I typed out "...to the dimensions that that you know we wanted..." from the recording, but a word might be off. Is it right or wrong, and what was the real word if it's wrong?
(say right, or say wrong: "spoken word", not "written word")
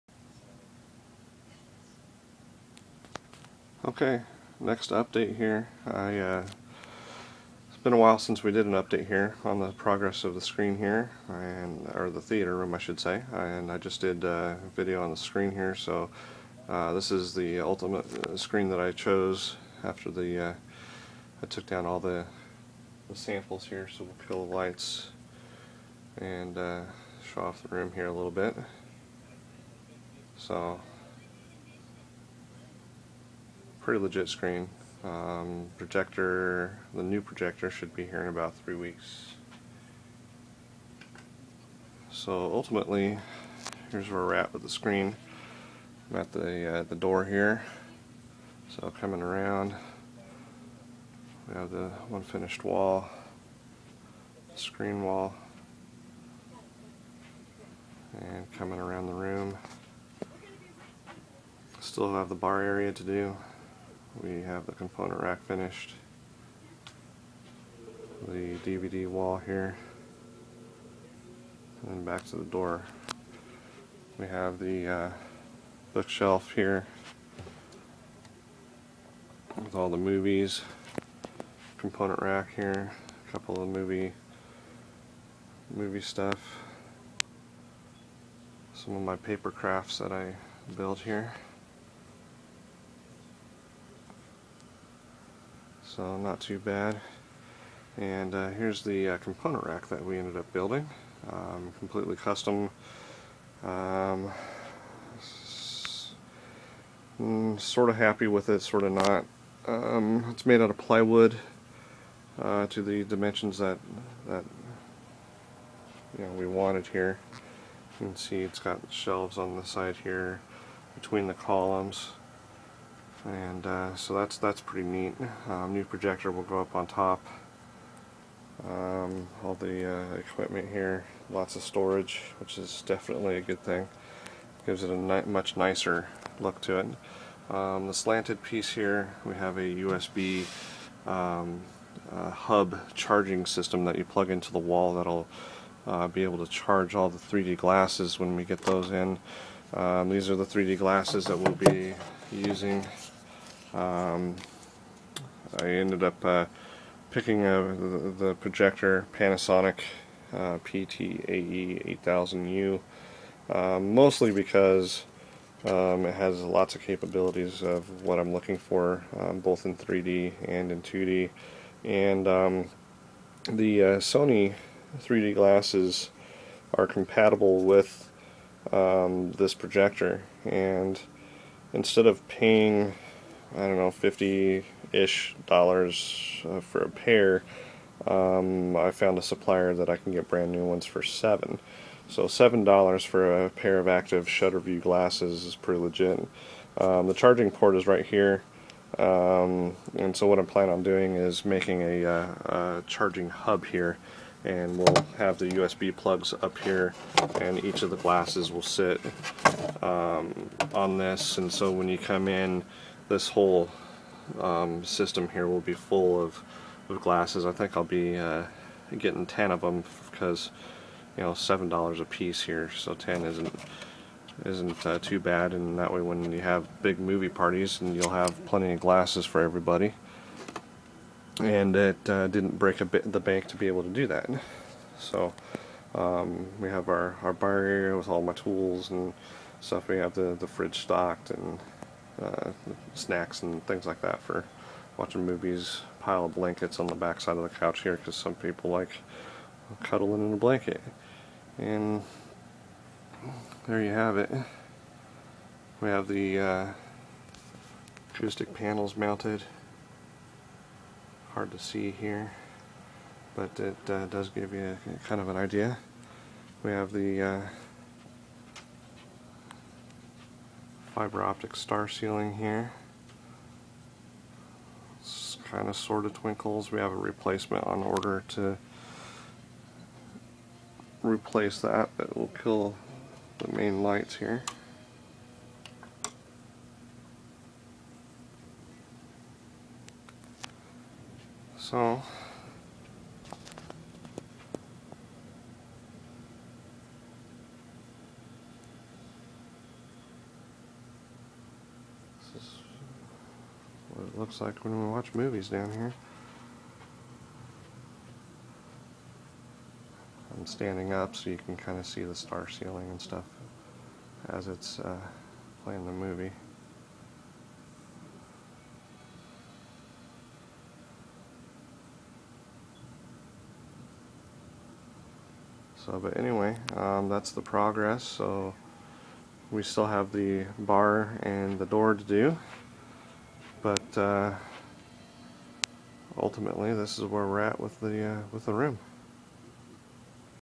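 right.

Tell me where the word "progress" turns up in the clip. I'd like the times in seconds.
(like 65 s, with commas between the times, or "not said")
9 s, 327 s.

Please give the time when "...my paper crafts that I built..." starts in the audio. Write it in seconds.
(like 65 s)
89 s.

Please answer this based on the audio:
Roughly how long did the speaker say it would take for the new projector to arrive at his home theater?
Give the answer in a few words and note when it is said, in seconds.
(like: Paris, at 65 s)
3 weeks, at 38 s.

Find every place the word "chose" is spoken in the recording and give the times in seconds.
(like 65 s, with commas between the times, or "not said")
18 s.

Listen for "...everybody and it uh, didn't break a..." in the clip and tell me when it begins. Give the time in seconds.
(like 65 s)
229 s.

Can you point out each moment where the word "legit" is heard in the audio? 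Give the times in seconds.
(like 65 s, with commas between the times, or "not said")
33 s, 195 s.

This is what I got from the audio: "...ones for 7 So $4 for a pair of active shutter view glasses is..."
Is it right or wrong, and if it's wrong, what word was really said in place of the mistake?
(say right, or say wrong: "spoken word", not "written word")
wrong: "7", not "4".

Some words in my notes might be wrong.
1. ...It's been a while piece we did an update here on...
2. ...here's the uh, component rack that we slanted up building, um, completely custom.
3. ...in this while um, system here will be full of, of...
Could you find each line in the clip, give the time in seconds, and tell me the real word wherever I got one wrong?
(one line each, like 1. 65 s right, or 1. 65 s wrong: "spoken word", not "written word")
1. 7 s wrong: "since", not "piece"
2. 98 s wrong: "ended", not "slanted"
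3. 212 s wrong: "whole", not "while".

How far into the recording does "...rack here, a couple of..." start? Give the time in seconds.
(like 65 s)
82 s.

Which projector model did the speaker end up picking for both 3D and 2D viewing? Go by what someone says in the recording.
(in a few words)
Panasonic PTAE 8000U.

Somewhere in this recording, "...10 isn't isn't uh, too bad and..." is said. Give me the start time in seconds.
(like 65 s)
222 s.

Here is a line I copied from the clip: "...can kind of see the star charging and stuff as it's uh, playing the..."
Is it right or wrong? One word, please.
wrong.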